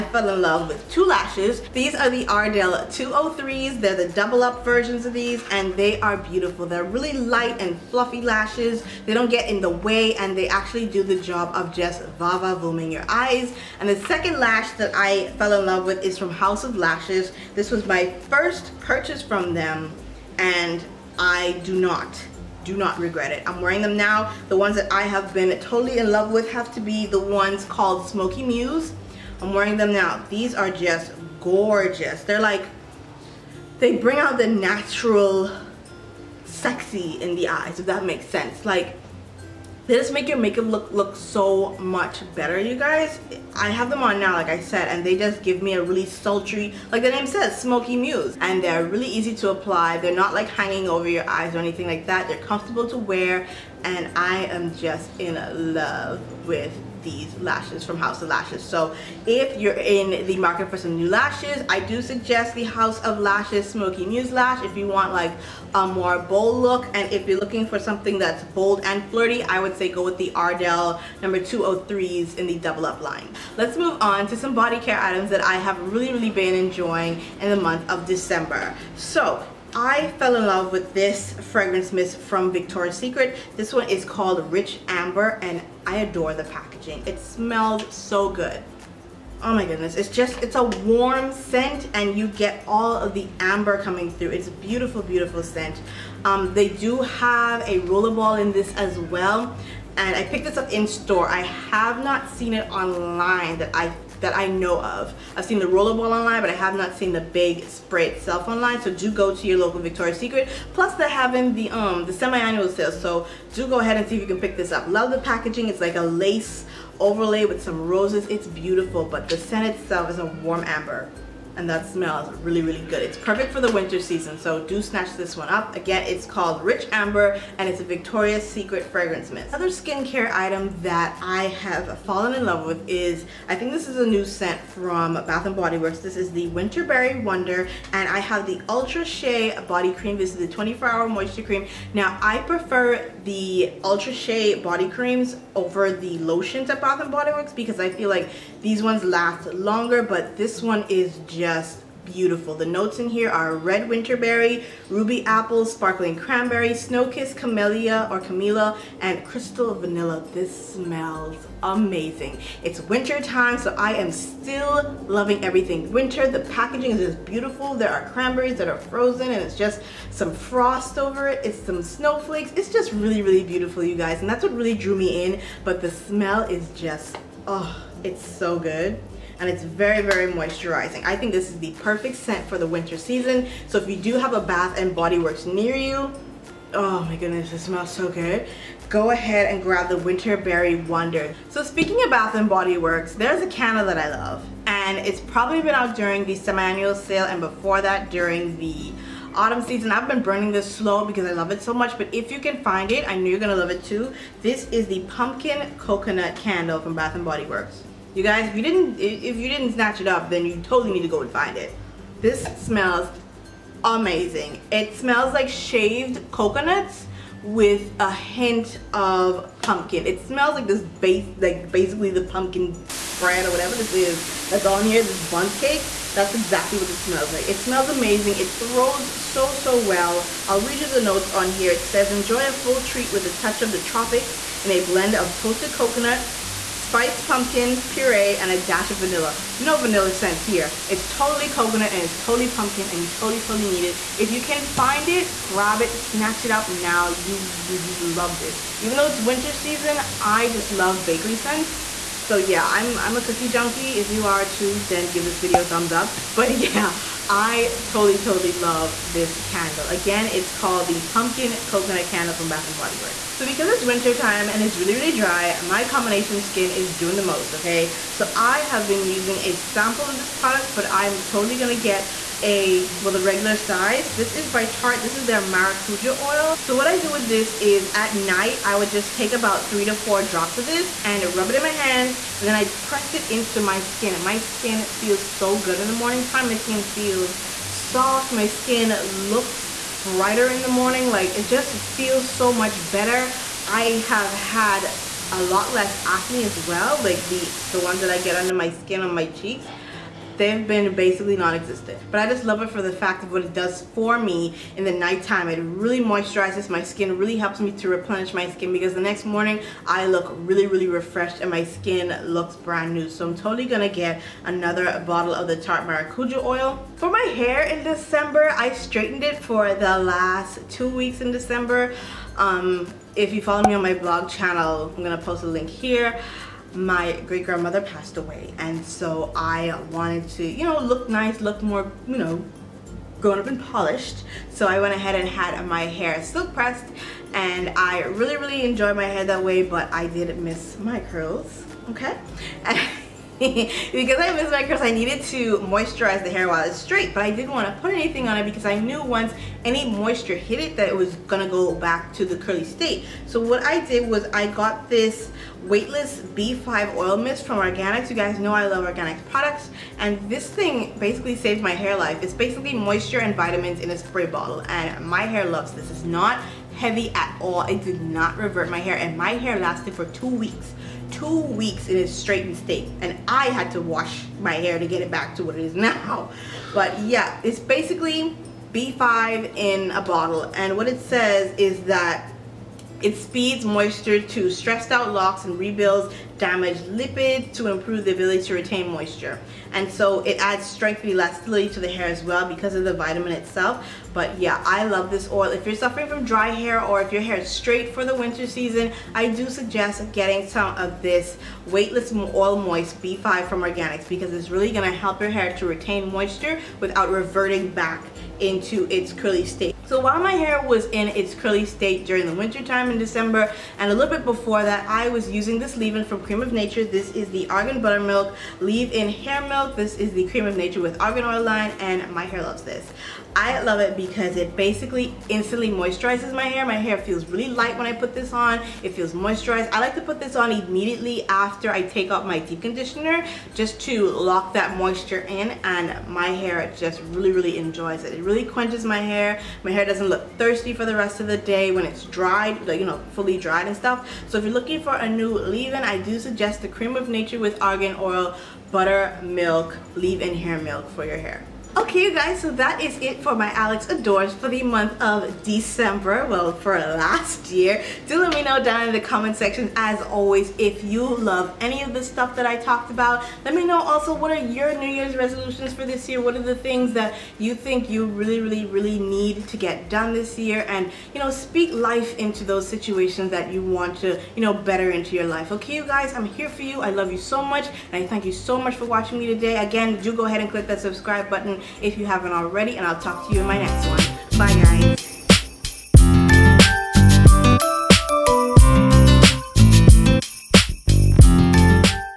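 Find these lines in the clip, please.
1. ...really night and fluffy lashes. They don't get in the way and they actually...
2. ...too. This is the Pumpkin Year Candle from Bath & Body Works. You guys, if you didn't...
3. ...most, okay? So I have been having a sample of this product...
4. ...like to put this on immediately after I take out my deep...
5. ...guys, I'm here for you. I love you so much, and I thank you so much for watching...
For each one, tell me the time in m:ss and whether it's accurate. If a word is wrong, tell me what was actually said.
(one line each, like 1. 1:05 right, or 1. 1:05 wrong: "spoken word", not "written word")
1. 0:06 wrong: "light", not "night"
2. 3:23 wrong: "Coconut", not "Year"
3. 4:27 wrong: "using", not "having"
4. 7:09 right
5. 7:55 right.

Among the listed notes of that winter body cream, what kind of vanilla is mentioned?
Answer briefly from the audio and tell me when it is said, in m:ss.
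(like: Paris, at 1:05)
Crystal vanilla, at 2:39.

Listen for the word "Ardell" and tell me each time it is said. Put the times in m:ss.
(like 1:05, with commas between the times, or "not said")
0:02, 1:10.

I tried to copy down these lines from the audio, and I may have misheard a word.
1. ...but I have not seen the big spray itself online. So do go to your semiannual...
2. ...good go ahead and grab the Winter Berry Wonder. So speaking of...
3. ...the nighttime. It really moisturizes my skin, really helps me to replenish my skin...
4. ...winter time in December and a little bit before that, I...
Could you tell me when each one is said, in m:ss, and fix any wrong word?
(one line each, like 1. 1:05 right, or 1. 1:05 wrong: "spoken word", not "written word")
1. 1:46 wrong: "local", not "semiannual"
2. 3:08 right
3. 5:04 right
4. 6:52 right.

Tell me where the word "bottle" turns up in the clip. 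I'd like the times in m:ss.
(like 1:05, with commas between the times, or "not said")
5:15, 6:04, 6:20.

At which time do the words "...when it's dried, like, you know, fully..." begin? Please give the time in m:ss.
7:21.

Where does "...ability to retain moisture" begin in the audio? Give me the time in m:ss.
6:28.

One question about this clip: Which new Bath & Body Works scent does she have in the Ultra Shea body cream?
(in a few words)
Winterberry Wonder.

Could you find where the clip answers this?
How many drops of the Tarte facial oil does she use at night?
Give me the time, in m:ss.
4:39.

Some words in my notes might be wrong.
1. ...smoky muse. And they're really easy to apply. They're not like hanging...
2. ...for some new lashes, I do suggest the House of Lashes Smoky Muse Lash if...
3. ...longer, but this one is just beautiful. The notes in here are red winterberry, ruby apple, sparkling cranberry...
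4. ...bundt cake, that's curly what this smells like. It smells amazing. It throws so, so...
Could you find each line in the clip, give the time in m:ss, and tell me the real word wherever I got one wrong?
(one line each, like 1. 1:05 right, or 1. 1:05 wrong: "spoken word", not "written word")
1. 0:47 right
2. 1:00 right
3. 2:29 right
4. 3:45 wrong: "exactly", not "curly".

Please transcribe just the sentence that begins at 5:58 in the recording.
You guys know I love Organix products, and this thing basically saves my hair life.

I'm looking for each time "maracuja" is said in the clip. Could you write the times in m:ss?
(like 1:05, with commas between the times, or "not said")
4:35, 5:15.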